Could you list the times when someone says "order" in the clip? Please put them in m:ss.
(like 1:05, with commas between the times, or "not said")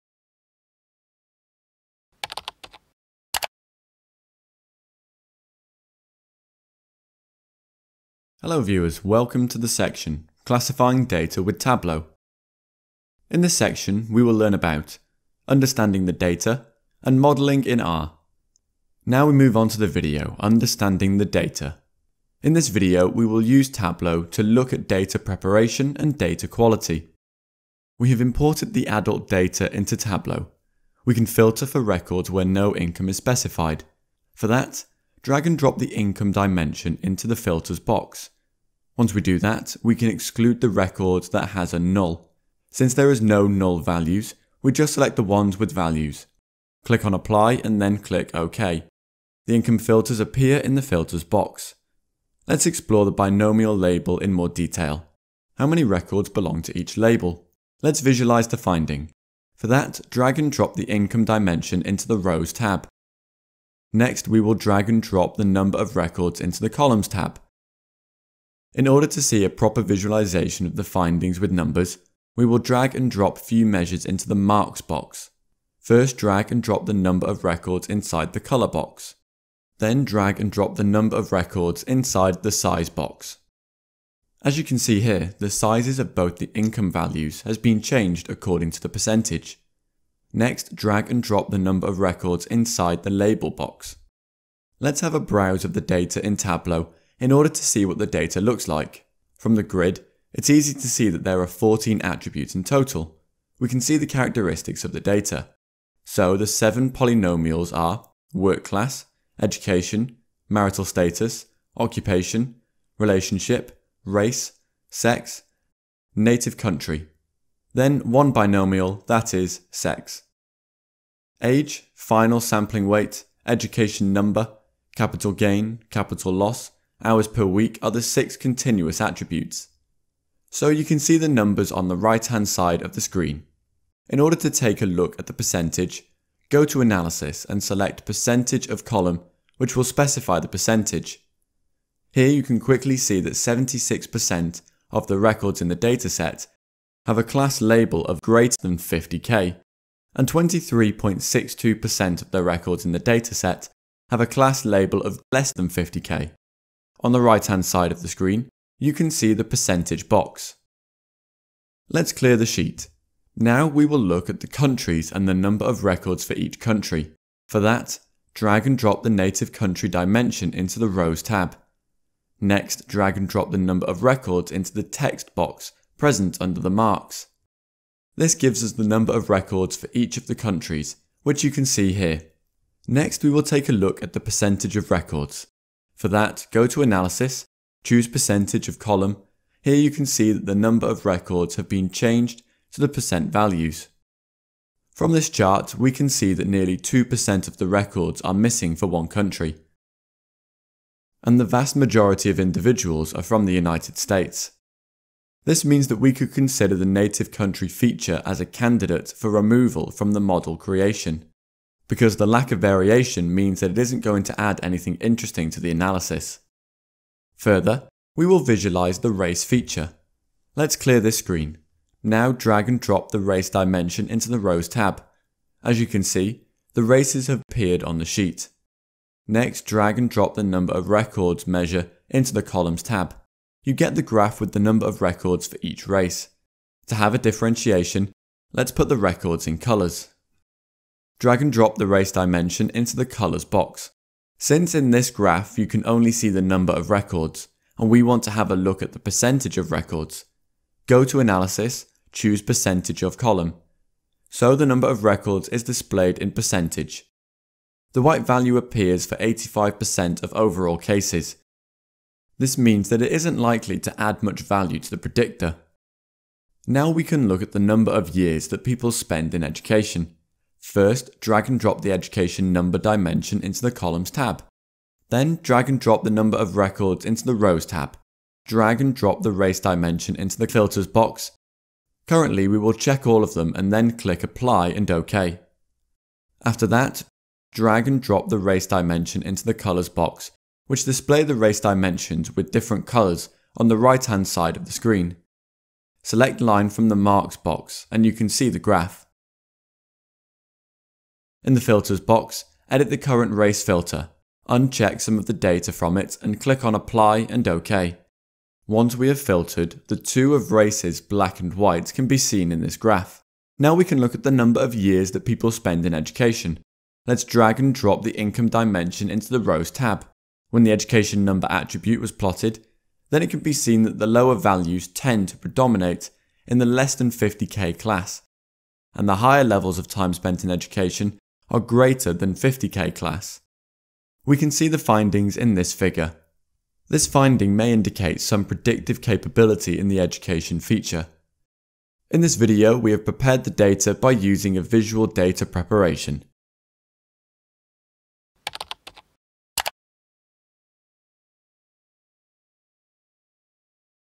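1:08, 1:37, 2:14.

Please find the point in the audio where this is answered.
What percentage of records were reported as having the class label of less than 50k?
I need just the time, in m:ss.
2:30.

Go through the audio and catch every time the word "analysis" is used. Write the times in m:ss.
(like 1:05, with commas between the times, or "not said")
2:16, 3:06, 3:35, 4:11.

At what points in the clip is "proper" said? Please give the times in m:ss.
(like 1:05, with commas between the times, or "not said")
1:09.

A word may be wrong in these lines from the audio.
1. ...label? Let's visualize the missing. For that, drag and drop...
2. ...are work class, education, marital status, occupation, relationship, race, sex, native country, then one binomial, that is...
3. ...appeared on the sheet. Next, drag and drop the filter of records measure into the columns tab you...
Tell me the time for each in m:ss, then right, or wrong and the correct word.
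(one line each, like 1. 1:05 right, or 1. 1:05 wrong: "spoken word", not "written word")
1. 0:56 wrong: "finding", not "missing"
2. 1:47 right
3. 3:47 wrong: "number", not "filter".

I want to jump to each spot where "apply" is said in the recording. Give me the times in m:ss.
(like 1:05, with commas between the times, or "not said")
0:47, 4:44, 5:06.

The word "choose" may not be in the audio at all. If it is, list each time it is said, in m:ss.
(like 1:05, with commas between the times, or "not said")
3:07, 4:12.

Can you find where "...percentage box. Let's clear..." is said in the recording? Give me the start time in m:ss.
2:39.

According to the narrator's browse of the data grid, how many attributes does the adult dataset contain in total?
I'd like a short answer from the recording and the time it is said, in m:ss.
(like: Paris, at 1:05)
14, at 1:41.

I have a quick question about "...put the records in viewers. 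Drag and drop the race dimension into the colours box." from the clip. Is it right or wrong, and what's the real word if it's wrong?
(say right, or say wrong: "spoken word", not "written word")
wrong: "colours", not "viewers".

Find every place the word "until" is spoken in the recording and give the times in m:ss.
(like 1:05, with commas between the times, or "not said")
not said.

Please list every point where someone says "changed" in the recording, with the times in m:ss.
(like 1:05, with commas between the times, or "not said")
1:27, 3:11.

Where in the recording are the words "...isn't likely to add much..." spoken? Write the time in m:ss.
4:23.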